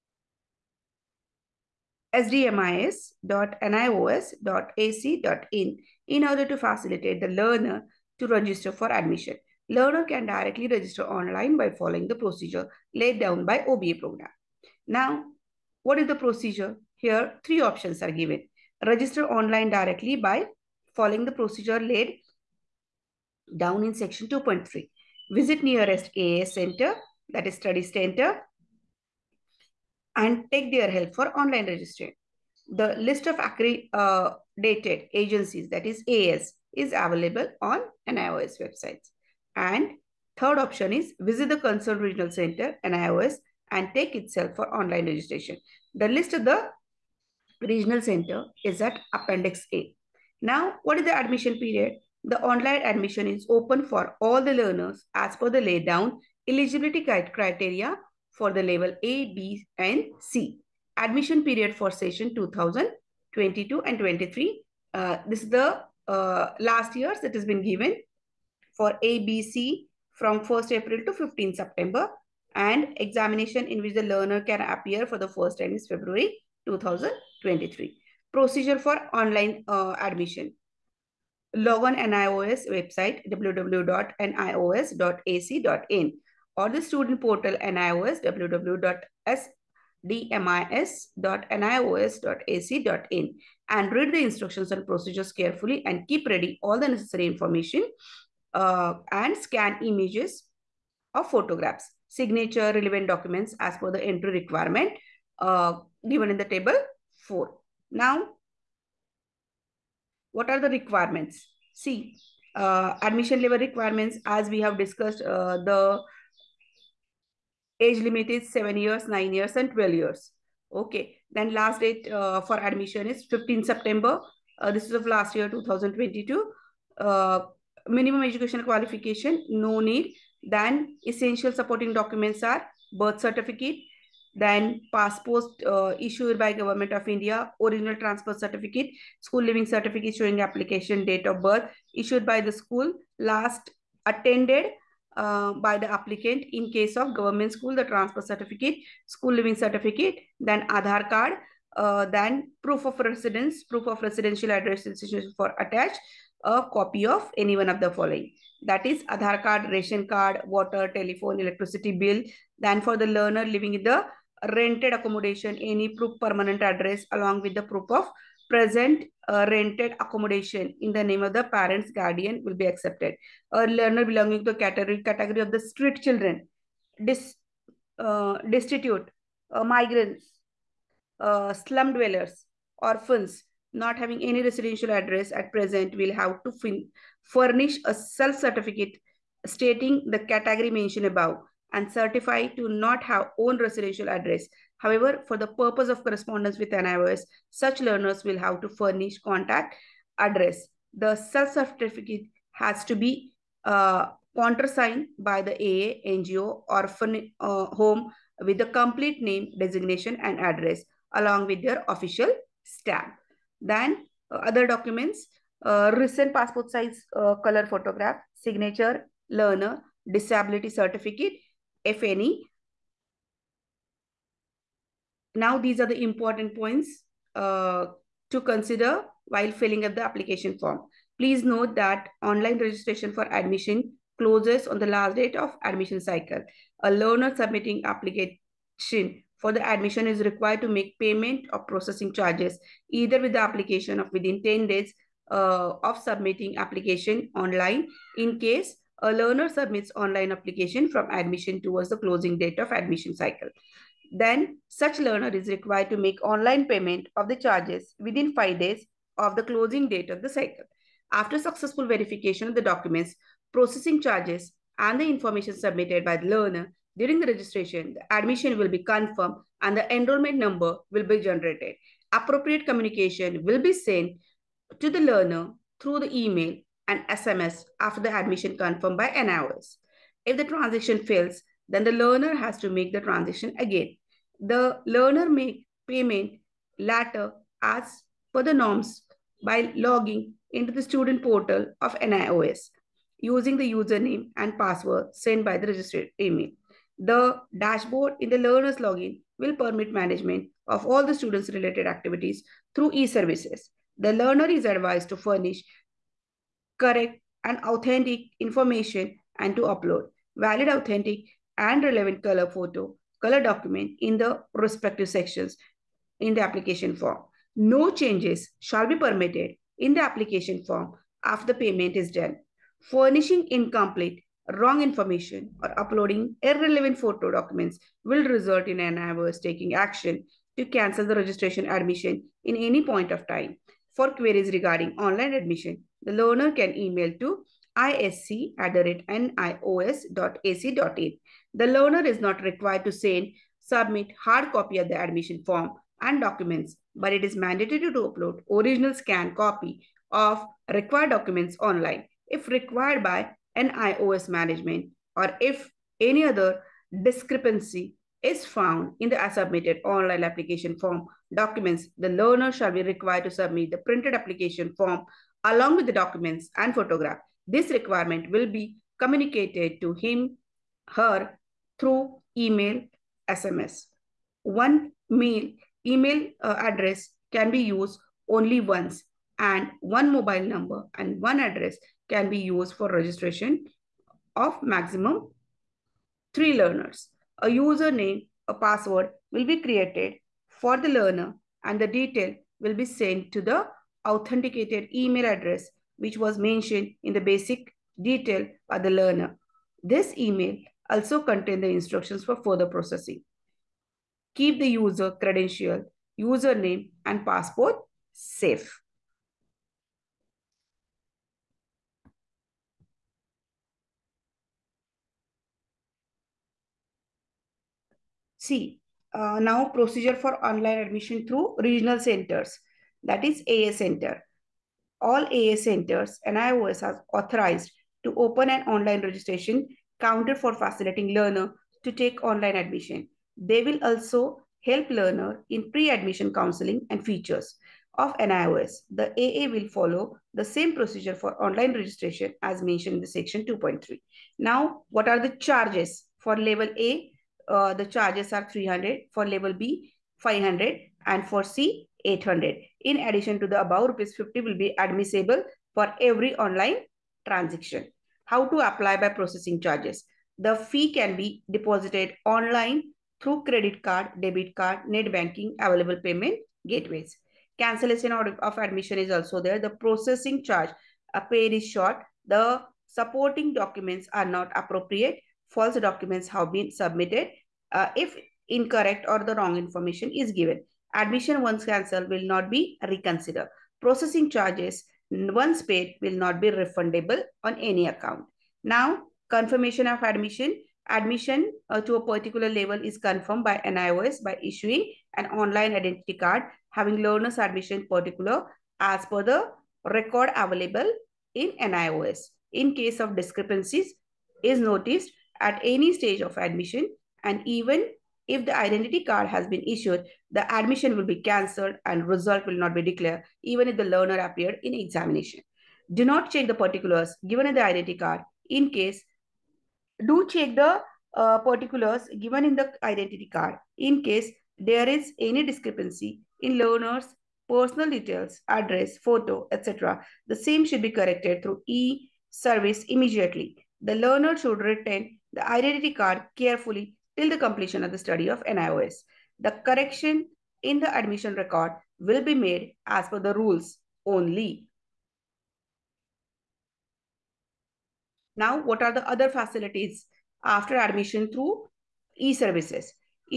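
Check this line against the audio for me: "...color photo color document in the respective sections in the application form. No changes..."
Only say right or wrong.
right.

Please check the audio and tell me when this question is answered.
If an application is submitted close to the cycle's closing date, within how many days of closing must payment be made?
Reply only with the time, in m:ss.
4:18.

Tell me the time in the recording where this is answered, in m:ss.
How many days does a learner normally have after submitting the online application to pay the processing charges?
4:04.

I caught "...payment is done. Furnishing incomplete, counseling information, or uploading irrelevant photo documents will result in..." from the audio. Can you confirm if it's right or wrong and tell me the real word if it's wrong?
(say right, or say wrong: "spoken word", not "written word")
wrong: "wrong", not "counseling".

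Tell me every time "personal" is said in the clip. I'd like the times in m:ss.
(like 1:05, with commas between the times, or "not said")
8:47.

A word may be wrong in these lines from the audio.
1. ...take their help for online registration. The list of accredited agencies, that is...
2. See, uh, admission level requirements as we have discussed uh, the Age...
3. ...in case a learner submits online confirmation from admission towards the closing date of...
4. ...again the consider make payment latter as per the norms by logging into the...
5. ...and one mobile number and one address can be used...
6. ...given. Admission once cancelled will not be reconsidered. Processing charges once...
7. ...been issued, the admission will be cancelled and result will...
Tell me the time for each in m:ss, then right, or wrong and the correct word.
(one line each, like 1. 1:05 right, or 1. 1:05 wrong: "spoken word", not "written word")
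1. 0:30 right
2. 1:51 right
3. 4:08 wrong: "application", not "confirmation"
4. 4:43 wrong: "learner", not "consider"
5. 6:19 right
6. 8:00 right
7. 8:29 right.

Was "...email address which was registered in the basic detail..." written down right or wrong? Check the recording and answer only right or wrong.
wrong.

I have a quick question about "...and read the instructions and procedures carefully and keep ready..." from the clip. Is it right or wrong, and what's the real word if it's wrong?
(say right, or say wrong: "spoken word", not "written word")
right.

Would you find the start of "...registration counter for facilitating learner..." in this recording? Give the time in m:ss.
7:09.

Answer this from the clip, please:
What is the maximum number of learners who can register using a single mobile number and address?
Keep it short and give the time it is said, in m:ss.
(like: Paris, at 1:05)
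3, at 6:26.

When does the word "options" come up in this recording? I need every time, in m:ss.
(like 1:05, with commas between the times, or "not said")
0:17, 0:40.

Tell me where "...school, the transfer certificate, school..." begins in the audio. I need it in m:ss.
2:27.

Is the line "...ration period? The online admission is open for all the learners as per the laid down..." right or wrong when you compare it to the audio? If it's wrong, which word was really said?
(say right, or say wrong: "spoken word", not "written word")
wrong: "admission", not "ration".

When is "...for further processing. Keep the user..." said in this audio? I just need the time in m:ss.
6:42.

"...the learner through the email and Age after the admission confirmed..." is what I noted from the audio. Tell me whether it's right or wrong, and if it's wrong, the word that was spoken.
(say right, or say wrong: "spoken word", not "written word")
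wrong: "SMS", not "Age".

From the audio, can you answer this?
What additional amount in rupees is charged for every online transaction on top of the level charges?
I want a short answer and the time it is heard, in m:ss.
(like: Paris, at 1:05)
50, at 7:33.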